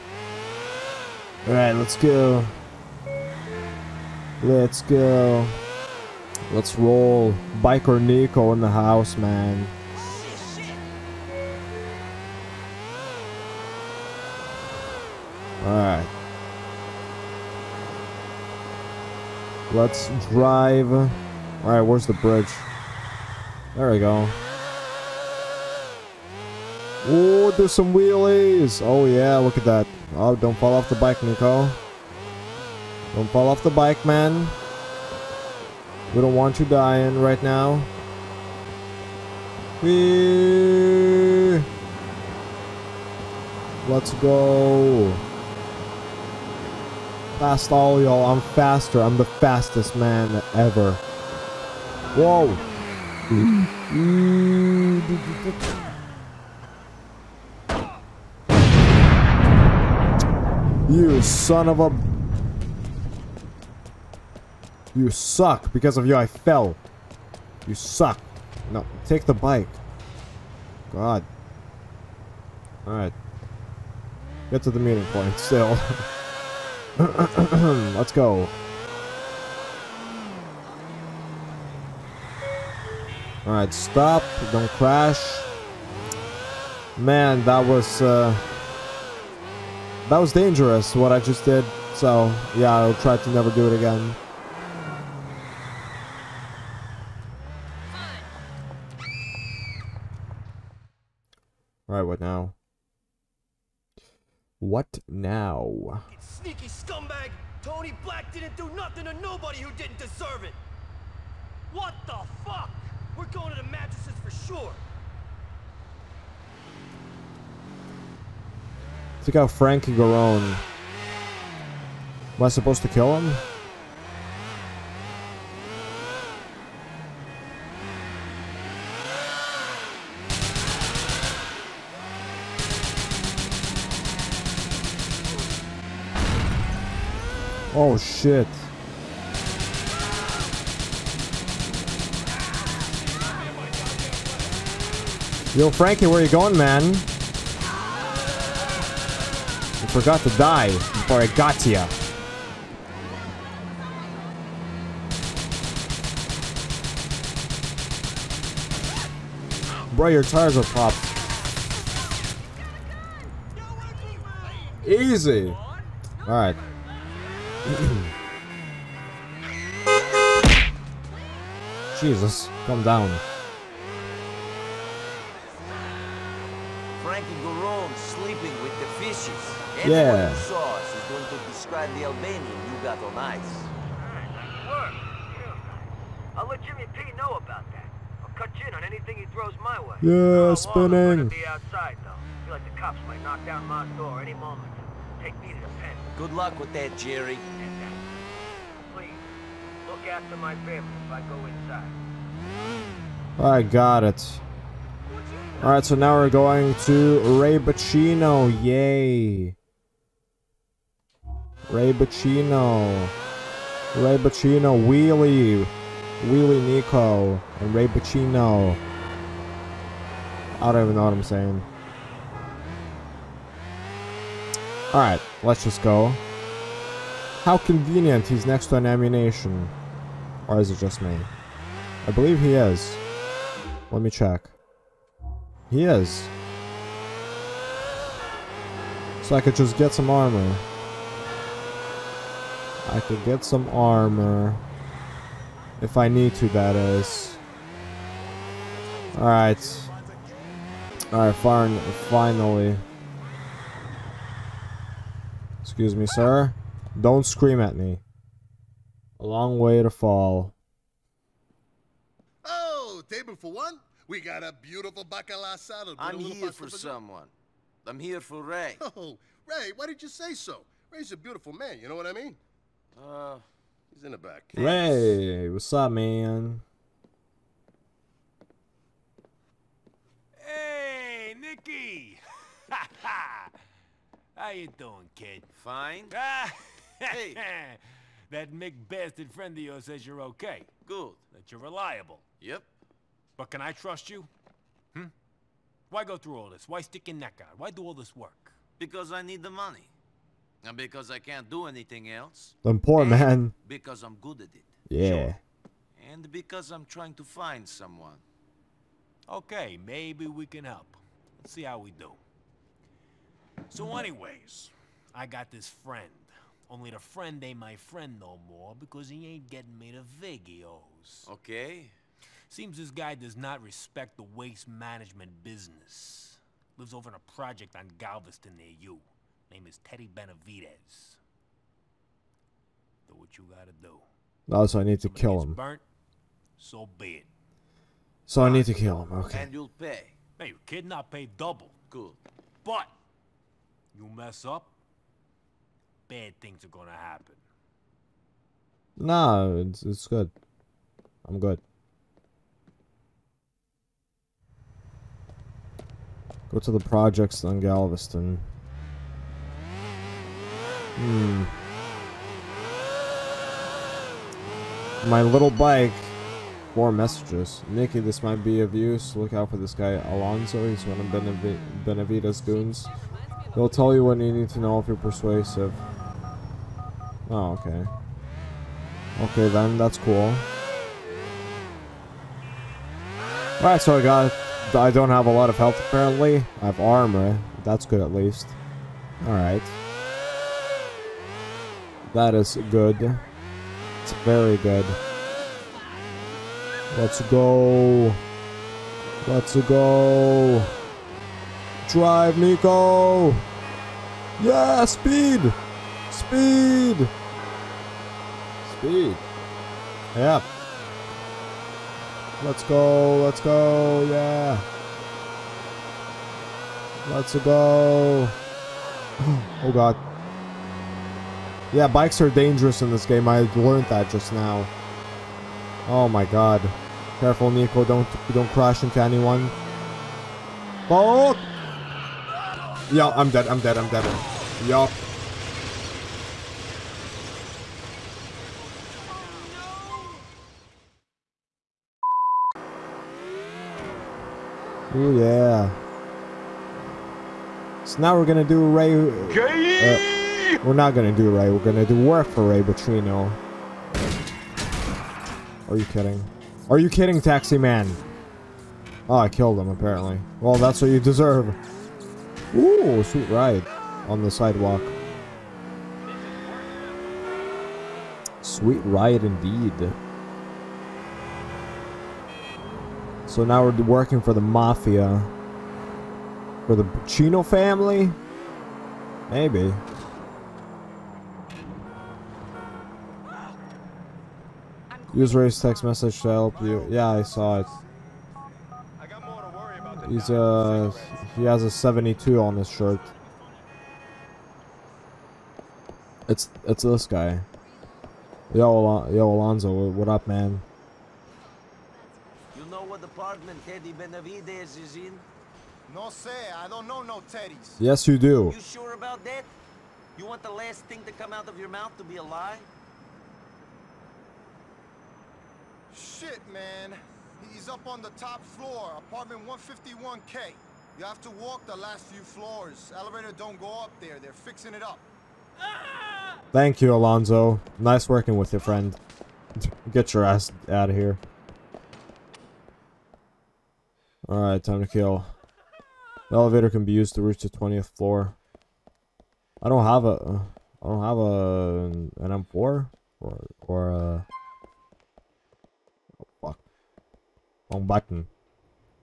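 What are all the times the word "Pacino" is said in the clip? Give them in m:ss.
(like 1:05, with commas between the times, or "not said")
7:56.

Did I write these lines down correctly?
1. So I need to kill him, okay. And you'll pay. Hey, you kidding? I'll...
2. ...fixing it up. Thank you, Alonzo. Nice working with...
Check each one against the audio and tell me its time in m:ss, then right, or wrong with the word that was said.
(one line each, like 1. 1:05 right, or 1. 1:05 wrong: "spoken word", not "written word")
1. 5:38 right
2. 8:44 right.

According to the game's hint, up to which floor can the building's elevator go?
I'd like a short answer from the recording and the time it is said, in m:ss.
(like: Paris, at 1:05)
20th floor, at 8:57.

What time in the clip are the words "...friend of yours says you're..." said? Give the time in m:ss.
4:49.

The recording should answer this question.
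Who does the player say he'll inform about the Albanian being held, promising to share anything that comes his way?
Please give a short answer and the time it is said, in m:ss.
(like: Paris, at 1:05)
Jimmy P, at 3:06.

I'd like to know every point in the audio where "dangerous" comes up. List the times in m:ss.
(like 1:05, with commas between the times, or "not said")
1:30, 7:02.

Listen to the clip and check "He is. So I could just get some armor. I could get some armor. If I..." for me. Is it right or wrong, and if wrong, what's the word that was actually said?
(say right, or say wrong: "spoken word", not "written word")
right.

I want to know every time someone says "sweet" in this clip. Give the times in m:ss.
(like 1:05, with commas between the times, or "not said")
7:43, 7:48.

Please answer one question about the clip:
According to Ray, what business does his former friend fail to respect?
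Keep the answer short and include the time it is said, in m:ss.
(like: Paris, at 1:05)
waste management, at 5:24.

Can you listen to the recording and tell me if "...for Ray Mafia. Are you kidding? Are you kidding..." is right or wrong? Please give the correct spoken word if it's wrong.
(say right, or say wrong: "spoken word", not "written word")
wrong: "Boccino", not "Mafia".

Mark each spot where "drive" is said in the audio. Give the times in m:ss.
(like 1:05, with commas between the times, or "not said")
0:20, 6:41.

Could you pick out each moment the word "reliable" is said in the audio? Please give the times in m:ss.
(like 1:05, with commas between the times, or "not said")
4:51.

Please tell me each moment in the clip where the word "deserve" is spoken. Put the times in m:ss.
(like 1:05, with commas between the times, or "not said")
1:49, 7:41.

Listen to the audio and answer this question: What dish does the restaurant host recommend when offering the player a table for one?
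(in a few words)
bacala salad.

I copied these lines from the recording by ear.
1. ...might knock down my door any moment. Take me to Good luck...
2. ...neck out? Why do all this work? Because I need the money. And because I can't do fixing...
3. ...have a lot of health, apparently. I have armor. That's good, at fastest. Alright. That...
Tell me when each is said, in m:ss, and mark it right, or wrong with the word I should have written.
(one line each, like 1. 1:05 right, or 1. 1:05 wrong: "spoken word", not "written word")
1. 3:13 right
2. 4:57 wrong: "anything", not "fixing"
3. 6:25 wrong: "least", not "fastest".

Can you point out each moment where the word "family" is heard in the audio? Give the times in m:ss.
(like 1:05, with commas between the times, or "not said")
3:20, 7:57.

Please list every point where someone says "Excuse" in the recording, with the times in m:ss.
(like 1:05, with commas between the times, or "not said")
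4:15.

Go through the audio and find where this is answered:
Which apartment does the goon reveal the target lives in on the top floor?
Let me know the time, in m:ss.
8:39.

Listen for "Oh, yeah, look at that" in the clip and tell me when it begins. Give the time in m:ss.
0:28.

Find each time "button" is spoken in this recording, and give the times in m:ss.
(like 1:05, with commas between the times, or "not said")
9:07.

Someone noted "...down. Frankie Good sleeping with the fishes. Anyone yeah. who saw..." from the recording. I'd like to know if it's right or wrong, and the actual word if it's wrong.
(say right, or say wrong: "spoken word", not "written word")
wrong: "Garone", not "Good".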